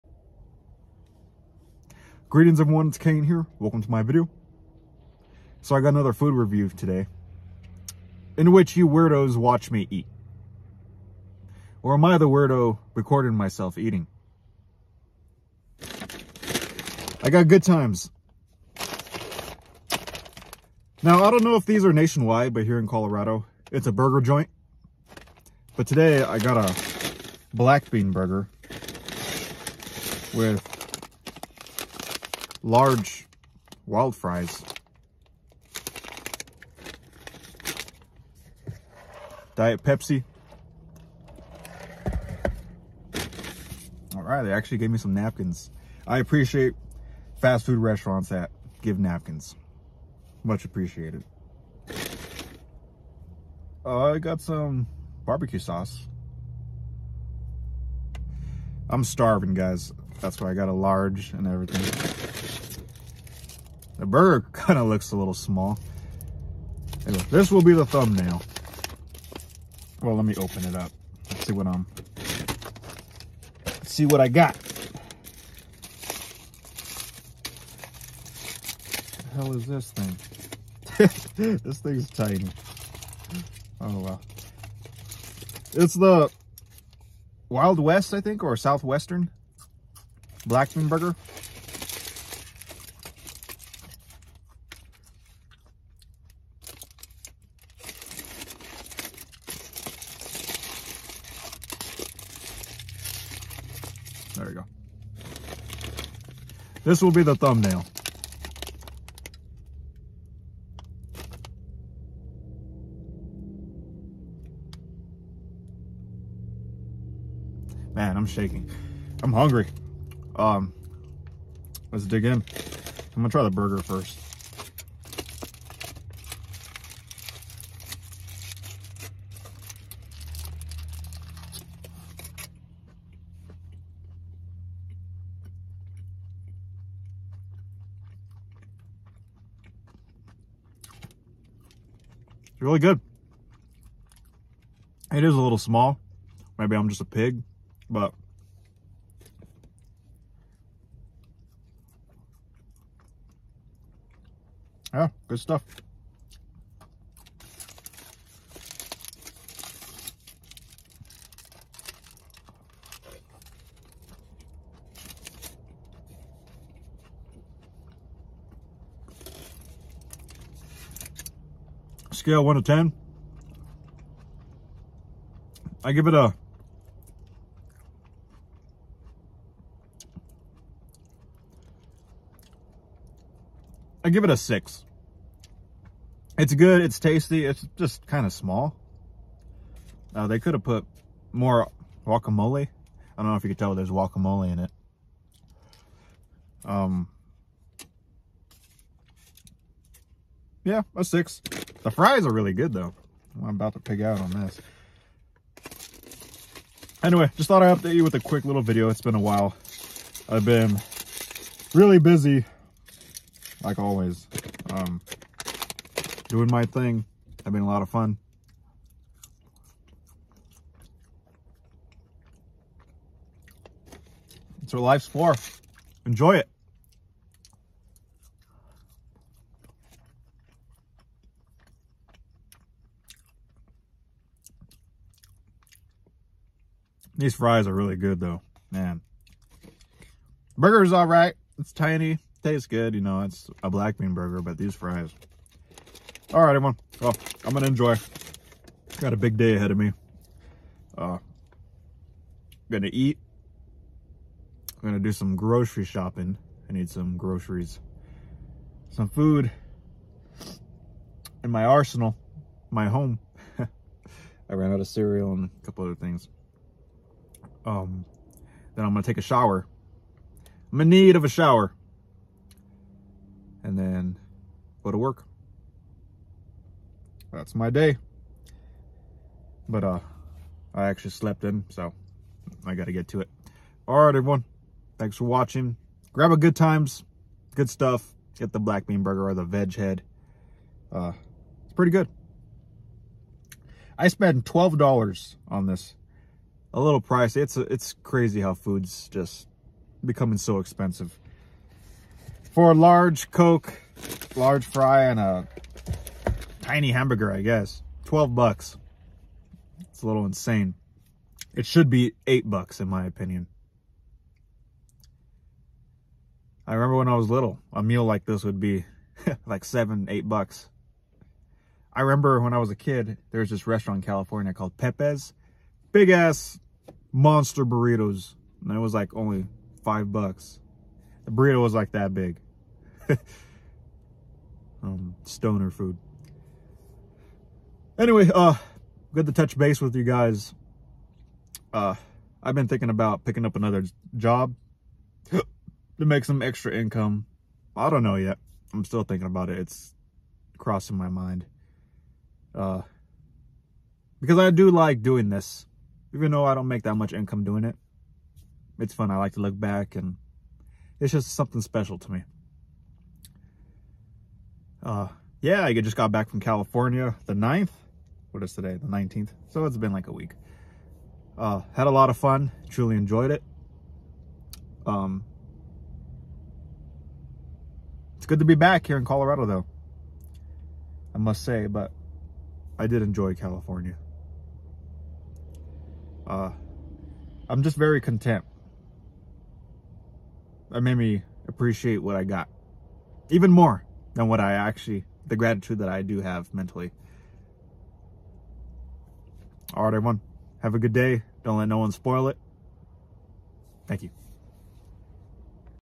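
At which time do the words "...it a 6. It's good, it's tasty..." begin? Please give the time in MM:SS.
03:04.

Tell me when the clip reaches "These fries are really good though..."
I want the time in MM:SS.
03:57.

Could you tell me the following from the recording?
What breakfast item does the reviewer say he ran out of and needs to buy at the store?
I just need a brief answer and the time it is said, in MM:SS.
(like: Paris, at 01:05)
cereal, at 04:24.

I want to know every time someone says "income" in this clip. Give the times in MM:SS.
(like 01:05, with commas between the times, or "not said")
05:46, 05:57.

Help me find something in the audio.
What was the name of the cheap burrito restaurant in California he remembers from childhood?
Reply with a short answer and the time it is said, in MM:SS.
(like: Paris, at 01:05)
Pepe's big ass monster burritos, at 05:24.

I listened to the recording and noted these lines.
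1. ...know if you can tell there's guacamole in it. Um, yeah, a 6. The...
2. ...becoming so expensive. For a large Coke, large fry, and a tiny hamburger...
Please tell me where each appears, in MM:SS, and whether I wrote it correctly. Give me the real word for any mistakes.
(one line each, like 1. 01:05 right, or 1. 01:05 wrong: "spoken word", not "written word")
1. 03:13 right
2. 05:00 right.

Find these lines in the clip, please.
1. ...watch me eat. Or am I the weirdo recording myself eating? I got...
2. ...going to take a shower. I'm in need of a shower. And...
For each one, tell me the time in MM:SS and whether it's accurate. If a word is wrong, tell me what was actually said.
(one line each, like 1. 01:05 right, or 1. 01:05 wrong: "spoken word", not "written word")
1. 00:09 right
2. 04:28 right.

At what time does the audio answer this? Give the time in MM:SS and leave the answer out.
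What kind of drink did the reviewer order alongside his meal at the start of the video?
00:39.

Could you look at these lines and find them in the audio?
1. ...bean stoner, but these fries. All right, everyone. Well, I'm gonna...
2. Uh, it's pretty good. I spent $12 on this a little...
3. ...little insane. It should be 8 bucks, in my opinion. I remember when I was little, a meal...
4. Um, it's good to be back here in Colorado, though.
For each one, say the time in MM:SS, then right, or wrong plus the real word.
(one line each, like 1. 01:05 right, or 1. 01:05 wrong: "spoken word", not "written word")
1. 04:03 wrong: "burger", not "stoner"
2. 04:50 right
3. 05:10 right
4. 06:14 right.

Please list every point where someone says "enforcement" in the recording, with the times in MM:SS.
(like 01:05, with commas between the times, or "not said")
not said.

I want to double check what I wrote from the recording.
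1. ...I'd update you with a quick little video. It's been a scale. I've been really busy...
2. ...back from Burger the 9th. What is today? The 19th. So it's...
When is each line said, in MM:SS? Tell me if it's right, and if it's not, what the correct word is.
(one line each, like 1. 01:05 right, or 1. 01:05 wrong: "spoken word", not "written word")
1. 03:27 wrong: "while", not "scale"
2. 06:06 wrong: "California", not "Burger".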